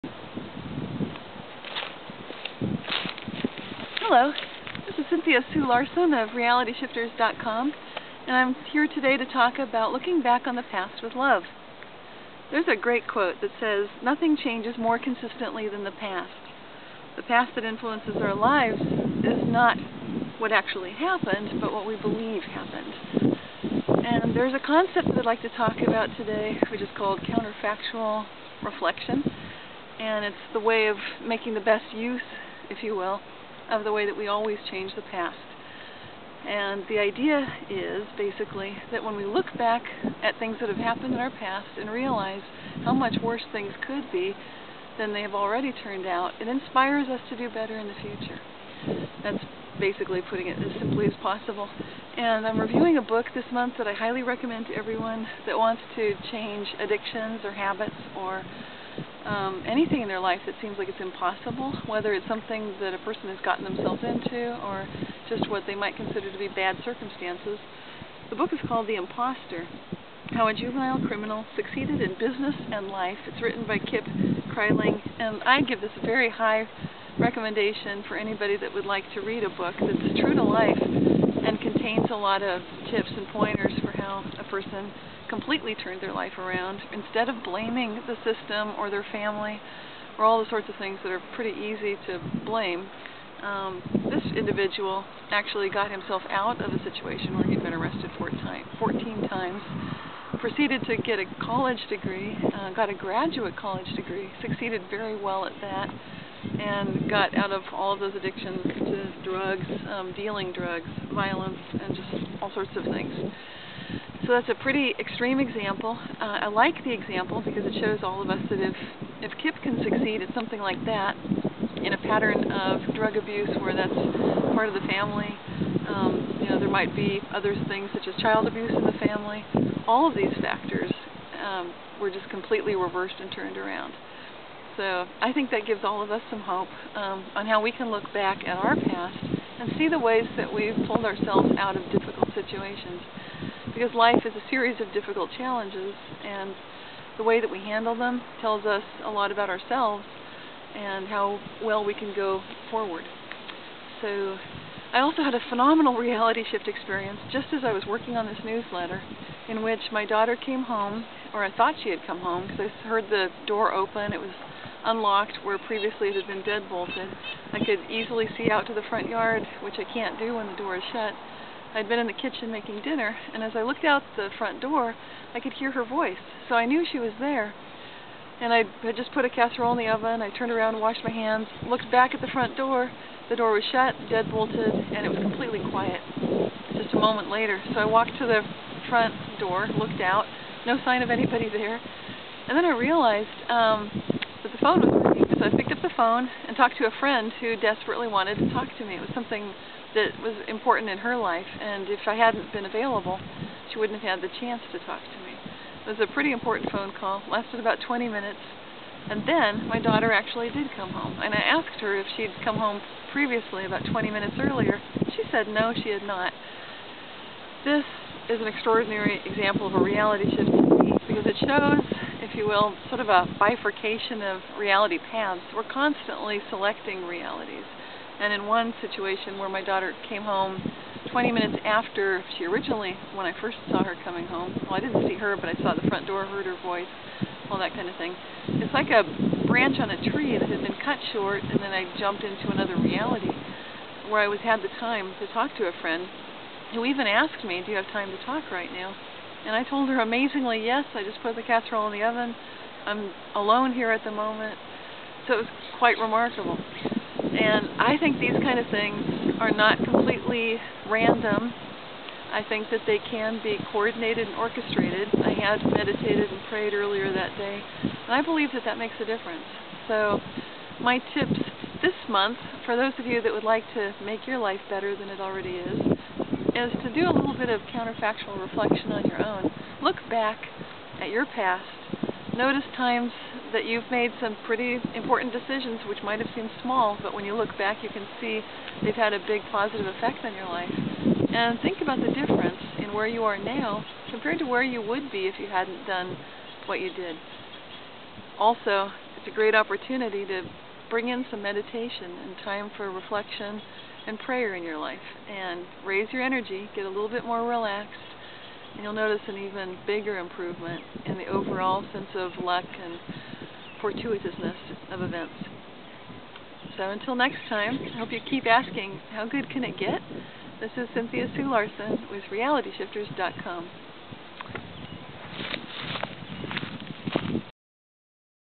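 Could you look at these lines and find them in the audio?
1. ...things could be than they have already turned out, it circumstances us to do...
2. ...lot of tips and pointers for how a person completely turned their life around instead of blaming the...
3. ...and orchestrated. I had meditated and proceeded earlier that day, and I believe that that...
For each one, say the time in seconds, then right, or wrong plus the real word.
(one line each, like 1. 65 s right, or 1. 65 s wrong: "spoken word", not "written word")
1. 43 s wrong: "inspires", not "circumstances"
2. 82 s right
3. 264 s wrong: "prayed", not "proceeded".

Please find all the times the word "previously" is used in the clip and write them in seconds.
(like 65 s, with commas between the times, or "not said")
165 s, 213 s.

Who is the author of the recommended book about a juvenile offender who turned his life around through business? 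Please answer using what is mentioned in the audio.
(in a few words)
Kip Kreiling.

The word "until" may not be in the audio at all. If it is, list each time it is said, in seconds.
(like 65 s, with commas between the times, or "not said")
316 s.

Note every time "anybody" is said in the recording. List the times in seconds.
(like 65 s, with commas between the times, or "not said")
78 s, 191 s.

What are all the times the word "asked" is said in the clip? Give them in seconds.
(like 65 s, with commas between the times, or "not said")
211 s, 247 s.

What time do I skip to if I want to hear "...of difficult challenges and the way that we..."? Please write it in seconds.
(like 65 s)
144 s.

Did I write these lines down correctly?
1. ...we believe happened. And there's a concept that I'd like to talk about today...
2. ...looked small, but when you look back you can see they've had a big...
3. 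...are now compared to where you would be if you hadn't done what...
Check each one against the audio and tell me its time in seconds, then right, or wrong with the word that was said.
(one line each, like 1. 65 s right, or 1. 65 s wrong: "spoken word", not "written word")
1. 21 s right
2. 286 s wrong: "seemed", not "looked"
3. 293 s right.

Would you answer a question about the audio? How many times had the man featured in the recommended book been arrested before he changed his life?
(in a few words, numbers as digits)
14.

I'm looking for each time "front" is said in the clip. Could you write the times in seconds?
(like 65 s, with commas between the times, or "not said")
168 s, 174 s, 182 s, 188 s, 235 s.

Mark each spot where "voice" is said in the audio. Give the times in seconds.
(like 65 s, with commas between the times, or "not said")
175 s, 236 s.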